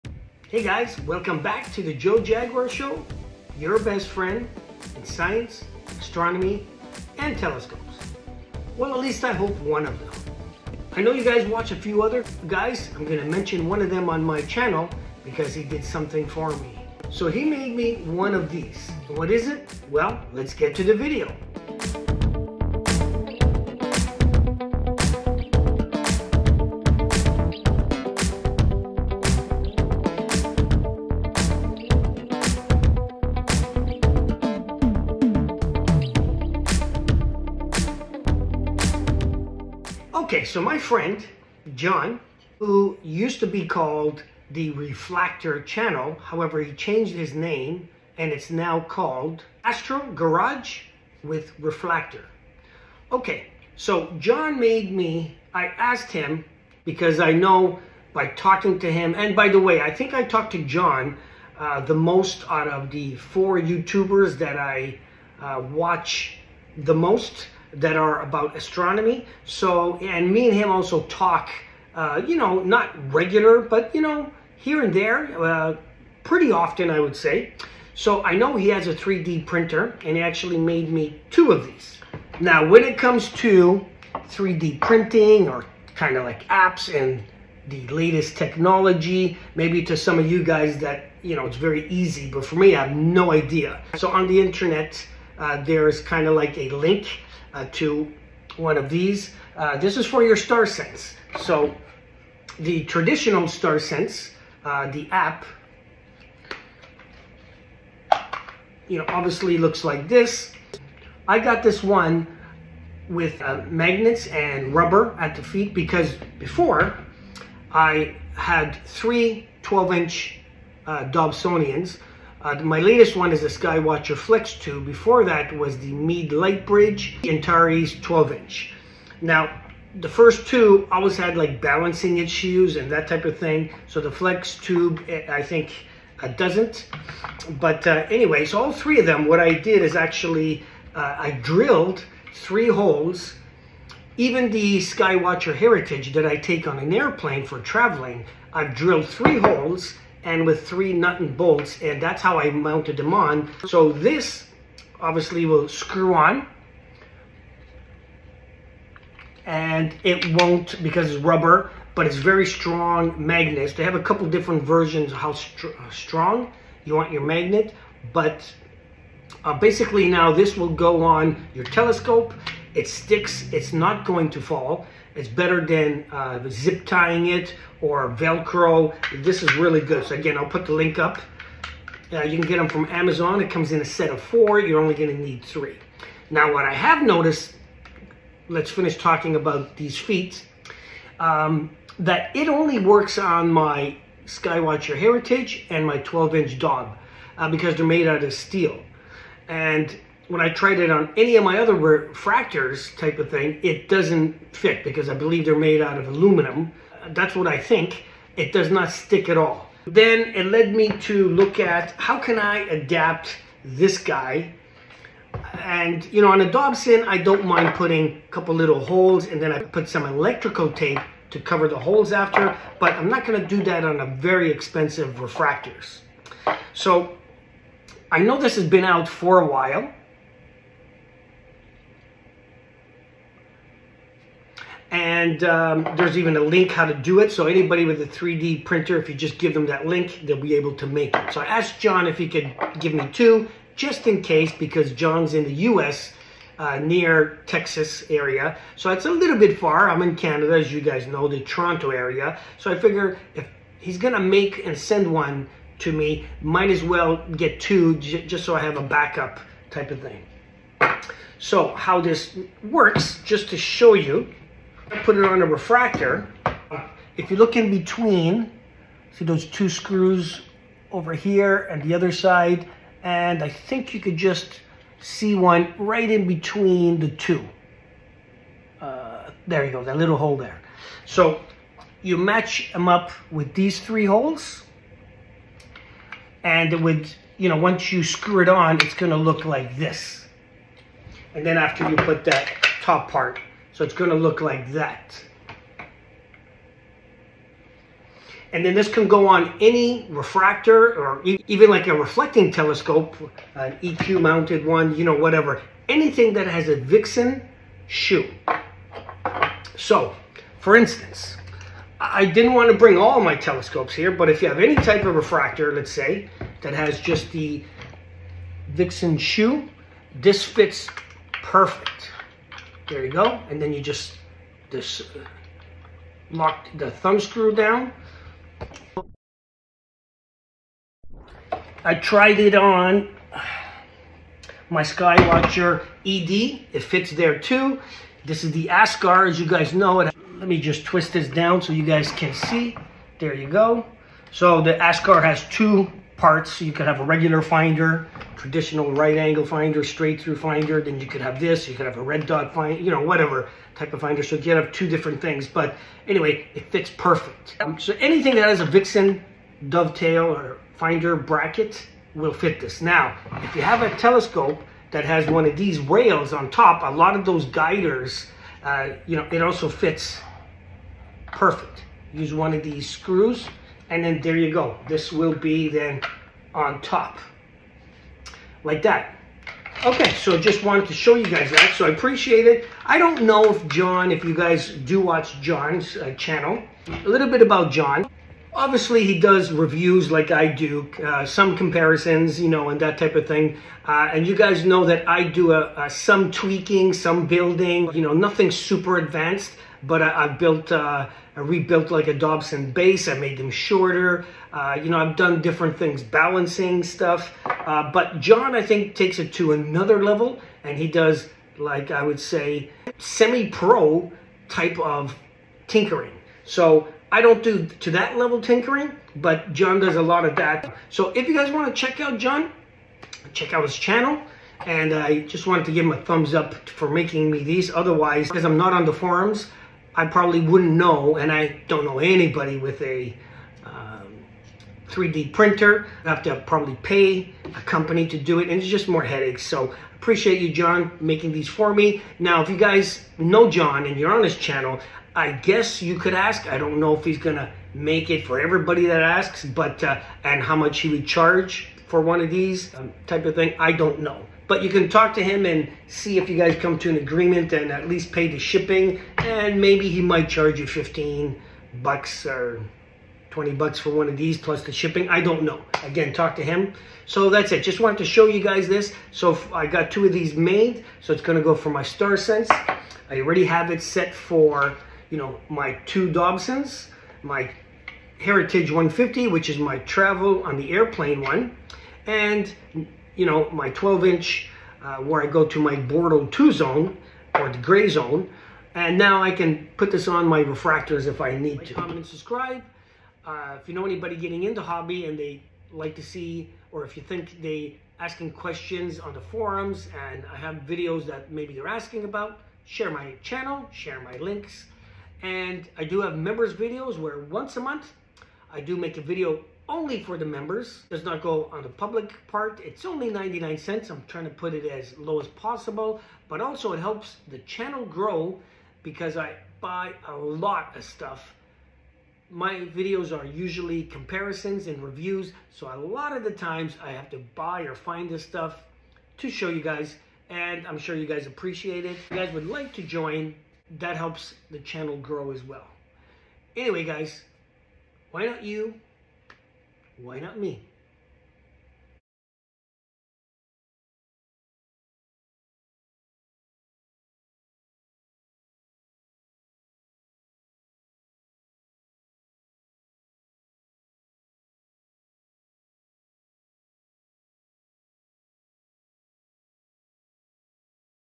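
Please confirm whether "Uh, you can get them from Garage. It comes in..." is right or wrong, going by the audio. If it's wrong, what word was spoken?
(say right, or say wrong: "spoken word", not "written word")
wrong: "Amazon", not "Garage".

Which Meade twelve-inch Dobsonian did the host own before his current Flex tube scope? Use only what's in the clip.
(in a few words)
Meade Lightbridge Antares.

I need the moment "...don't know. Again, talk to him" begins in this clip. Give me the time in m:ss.
7:45.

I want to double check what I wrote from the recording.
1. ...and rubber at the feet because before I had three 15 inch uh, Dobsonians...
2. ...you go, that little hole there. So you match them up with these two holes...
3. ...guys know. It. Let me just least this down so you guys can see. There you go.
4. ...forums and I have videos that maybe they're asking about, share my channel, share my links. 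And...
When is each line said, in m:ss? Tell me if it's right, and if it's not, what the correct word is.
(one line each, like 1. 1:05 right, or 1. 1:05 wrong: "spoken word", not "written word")
1. 1:54 wrong: "12", not "15"
2. 4:39 wrong: "three", not "two"
3. 5:39 wrong: "twist", not "least"
4. 8:19 right.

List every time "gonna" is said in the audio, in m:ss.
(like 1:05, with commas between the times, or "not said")
4:13, 4:48, 4:53, 7:27.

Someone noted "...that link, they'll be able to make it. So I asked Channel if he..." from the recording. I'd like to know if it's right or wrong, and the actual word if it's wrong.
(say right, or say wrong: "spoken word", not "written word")
wrong: "John", not "Channel".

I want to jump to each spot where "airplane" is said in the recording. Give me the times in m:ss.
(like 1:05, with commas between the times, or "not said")
2:26, 8:00.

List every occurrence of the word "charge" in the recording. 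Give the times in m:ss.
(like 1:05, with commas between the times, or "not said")
7:31, 7:40.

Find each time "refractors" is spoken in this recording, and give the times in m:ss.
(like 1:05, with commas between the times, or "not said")
3:21, 3:45, 4:25, 5:00, 5:15, 8:10.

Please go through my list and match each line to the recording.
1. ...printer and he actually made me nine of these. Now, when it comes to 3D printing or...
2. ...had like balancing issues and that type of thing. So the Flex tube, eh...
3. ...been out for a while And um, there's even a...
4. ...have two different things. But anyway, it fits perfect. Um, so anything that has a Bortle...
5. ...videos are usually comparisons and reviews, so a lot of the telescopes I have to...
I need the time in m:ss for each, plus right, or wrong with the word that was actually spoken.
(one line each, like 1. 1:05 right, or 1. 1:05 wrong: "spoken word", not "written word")
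1. 1:19 wrong: "two", not "nine"
2. 2:11 right
3. 3:48 right
4. 5:54 wrong: "Vixen", not "Bortle"
5. 8:42 wrong: "times", not "telescopes".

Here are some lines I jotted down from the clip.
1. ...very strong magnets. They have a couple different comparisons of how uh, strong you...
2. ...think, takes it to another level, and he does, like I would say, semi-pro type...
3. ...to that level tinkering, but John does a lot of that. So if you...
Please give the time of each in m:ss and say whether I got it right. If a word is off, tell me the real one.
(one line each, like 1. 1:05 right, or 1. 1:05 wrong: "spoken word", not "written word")
1. 2:42 wrong: "versions", not "comparisons"
2. 6:48 right
3. 6:57 right.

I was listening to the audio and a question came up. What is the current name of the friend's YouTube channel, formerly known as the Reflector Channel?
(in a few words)
Astro Garage with Reflector.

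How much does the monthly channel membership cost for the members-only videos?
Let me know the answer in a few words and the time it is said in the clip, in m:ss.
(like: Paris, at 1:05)
99 cents, at 8:33.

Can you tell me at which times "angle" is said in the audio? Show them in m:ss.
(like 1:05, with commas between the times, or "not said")
5:49.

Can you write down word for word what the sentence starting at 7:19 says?
So appreciate you, John, making these for me.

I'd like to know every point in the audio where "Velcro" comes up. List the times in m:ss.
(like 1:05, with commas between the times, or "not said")
2:58.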